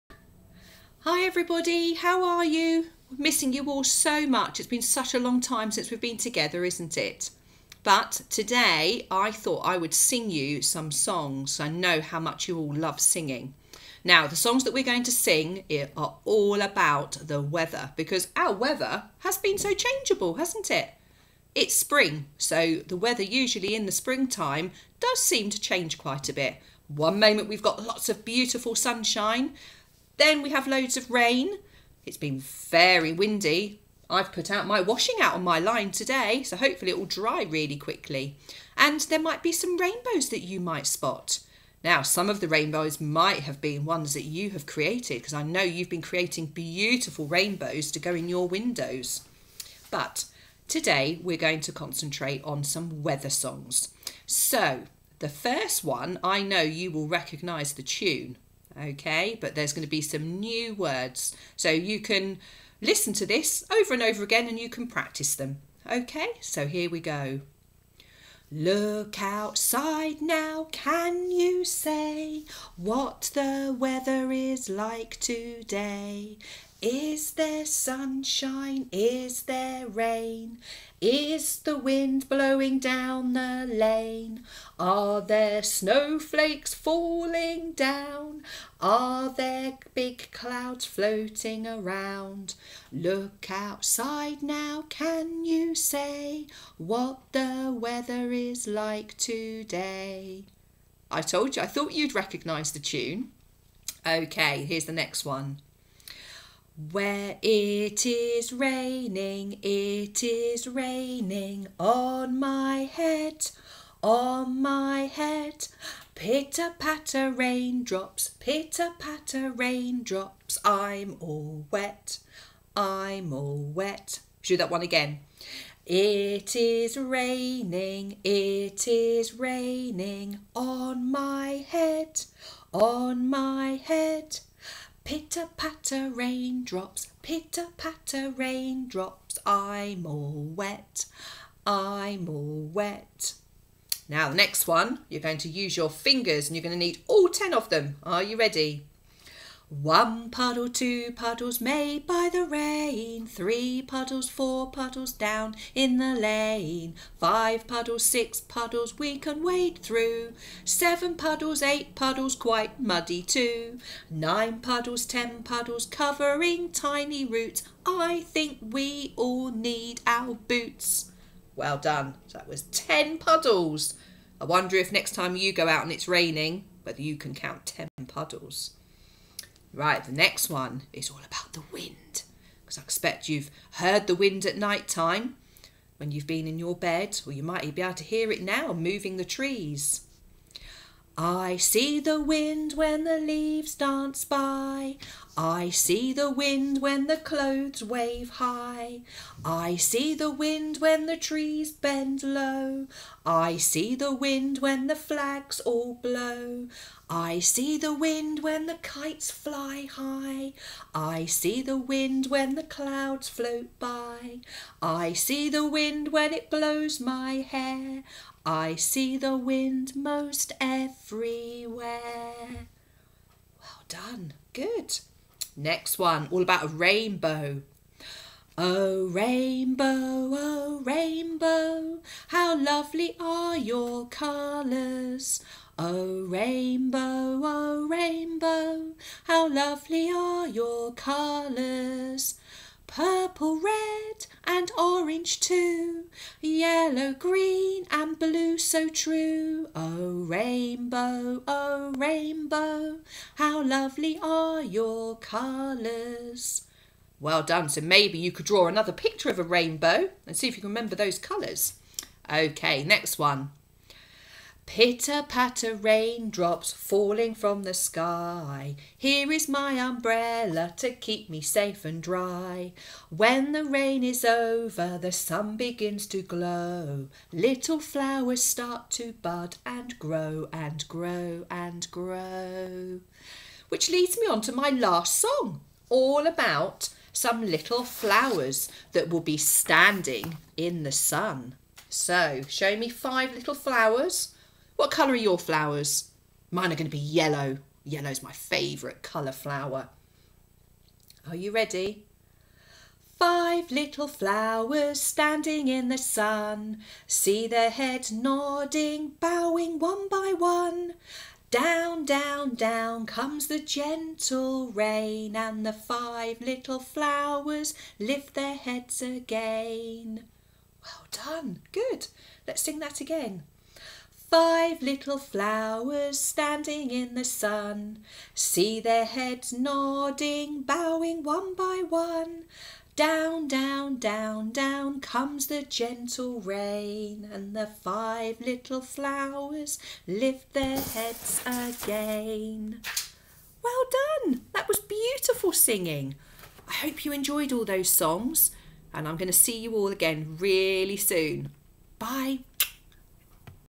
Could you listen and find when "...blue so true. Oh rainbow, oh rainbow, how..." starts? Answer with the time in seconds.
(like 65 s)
248 s.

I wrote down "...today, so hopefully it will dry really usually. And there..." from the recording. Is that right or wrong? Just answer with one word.
wrong.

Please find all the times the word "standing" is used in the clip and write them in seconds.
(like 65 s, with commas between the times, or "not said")
289 s, 304 s, 326 s.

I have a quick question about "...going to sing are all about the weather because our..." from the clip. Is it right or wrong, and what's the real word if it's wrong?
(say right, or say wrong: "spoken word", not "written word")
right.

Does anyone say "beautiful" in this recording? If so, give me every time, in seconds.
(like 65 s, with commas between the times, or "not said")
28 s, 46 s, 344 s.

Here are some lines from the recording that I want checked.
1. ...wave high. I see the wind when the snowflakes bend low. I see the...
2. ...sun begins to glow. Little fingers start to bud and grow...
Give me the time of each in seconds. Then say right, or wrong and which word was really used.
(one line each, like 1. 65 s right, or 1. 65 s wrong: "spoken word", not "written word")
1. 197 s wrong: "trees", not "snowflakes"
2. 275 s wrong: "flowers", not "fingers".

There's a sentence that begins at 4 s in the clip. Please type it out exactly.
It's been such a long time since we've been together, isn't it?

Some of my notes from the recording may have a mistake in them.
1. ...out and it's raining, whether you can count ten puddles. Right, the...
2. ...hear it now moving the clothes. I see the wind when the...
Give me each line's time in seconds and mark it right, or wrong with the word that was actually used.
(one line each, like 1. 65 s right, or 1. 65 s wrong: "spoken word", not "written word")
1. 175 s right
2. 188 s wrong: "trees", not "clothes".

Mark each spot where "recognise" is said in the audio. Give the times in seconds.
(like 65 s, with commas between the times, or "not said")
57 s, 102 s.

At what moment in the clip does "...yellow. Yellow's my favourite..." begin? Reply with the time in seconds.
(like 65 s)
296 s.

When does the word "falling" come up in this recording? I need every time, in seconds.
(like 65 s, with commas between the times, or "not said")
86 s, 266 s.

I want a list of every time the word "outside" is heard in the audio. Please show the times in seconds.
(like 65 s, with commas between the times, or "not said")
69 s, 93 s.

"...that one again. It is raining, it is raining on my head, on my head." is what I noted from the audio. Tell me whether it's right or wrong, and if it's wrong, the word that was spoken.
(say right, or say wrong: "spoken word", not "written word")
right.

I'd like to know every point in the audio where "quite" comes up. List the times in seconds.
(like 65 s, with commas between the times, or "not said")
25 s, 162 s.